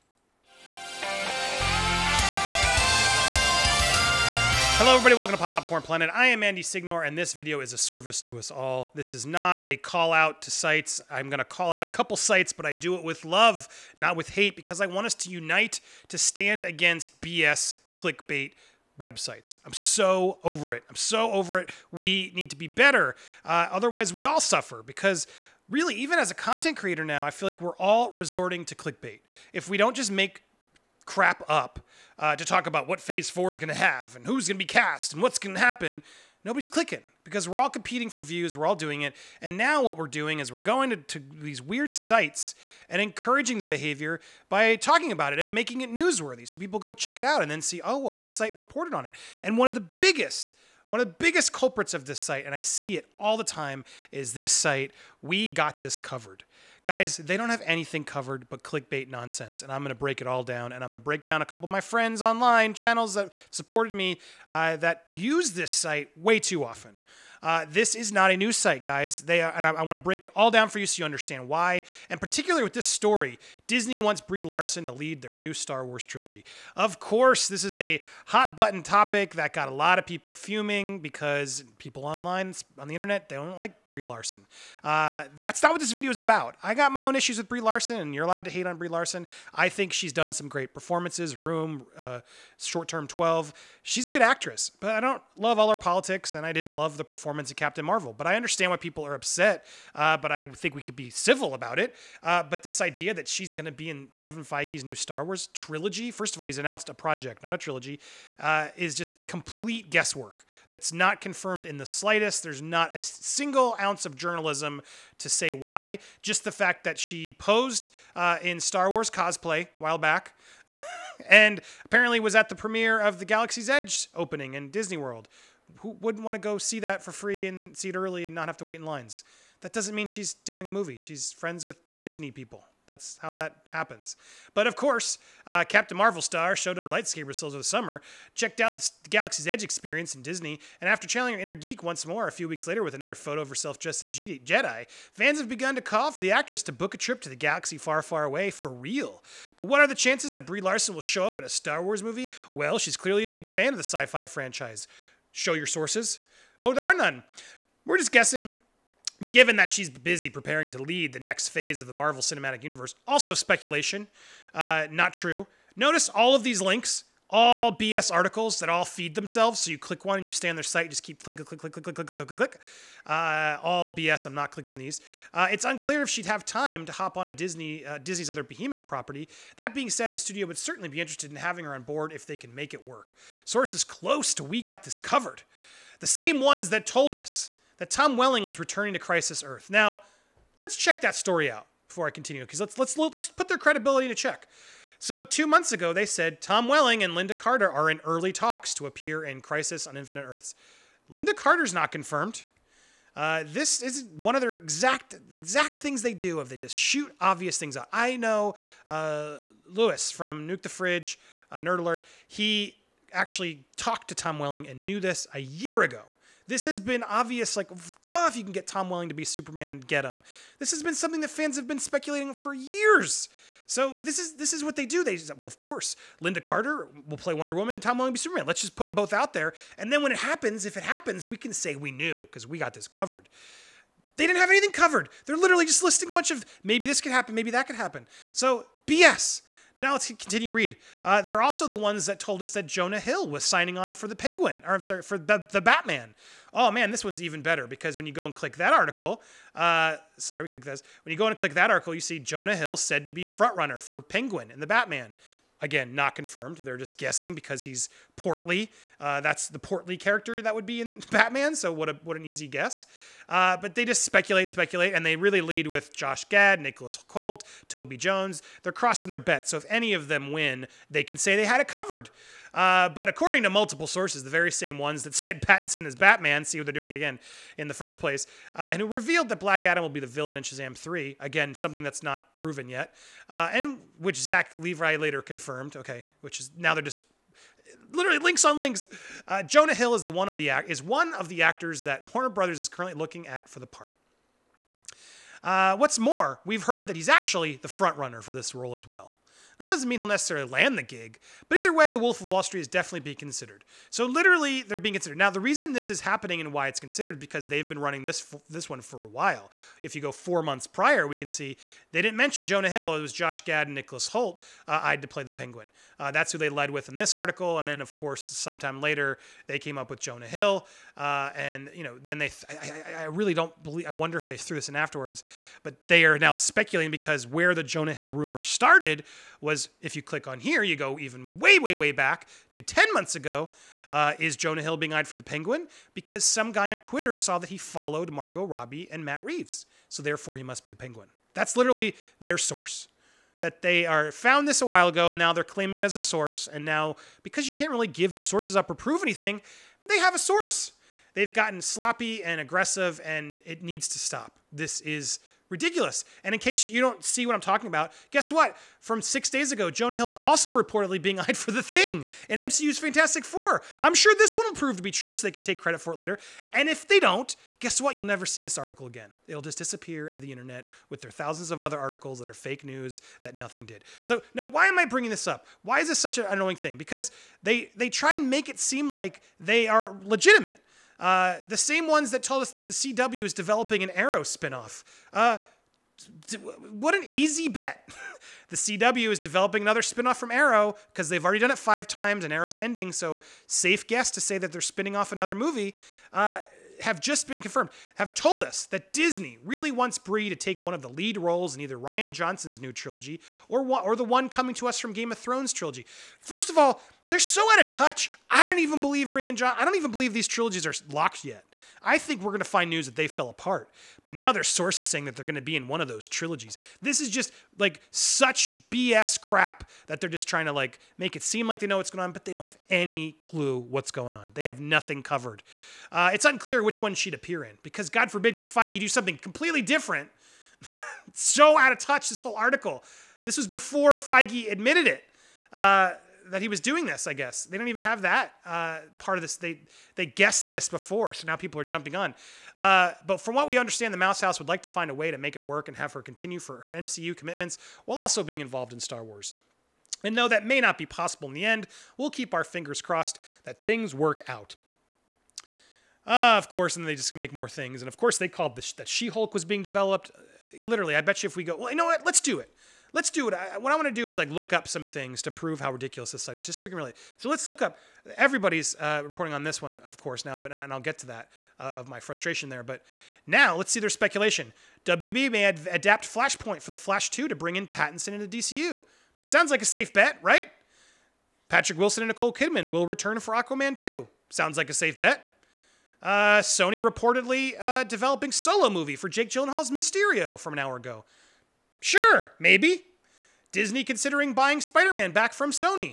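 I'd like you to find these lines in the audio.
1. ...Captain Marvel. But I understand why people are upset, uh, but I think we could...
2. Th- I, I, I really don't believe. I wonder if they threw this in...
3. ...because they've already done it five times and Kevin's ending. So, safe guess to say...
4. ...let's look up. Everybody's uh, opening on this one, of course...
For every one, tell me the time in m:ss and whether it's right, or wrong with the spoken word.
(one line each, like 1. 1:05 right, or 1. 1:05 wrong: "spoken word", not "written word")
1. 1:37 right
2. 5:22 right
3. 6:30 wrong: "Arrow", not "Kevin"
4. 7:47 wrong: "reporting", not "opening".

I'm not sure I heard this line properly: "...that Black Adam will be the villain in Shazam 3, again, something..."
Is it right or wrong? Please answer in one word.
right.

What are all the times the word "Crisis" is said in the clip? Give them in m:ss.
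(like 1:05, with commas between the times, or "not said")
3:09, 3:19.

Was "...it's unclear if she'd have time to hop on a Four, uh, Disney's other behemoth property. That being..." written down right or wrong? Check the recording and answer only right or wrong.
wrong.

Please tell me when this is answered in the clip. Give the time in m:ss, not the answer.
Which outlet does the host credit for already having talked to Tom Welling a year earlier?
3:30.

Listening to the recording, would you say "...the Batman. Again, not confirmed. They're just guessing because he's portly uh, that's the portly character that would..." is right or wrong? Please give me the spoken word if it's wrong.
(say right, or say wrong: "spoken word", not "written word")
right.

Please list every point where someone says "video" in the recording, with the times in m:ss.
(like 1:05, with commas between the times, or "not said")
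0:07, 1:25.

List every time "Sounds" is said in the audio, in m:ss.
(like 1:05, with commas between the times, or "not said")
7:59, 8:04.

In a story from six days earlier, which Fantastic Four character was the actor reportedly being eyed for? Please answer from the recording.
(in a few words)
The Thing.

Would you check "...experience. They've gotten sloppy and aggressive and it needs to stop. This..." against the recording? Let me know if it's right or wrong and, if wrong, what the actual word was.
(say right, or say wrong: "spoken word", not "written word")
wrong: "source", not "experience".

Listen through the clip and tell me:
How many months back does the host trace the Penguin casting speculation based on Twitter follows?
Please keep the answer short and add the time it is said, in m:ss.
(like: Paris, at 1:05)
10, at 5:32.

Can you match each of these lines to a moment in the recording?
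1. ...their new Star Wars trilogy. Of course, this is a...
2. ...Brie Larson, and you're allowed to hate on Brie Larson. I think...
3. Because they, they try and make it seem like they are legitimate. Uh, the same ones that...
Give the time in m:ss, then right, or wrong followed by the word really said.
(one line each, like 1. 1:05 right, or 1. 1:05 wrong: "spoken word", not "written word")
1. 1:15 right
2. 1:27 right
3. 6:16 right.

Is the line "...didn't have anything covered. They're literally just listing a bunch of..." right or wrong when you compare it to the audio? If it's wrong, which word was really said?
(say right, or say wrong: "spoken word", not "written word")
right.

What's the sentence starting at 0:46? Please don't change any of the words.
So people go check it out and then see, oh, well, this site reported on it.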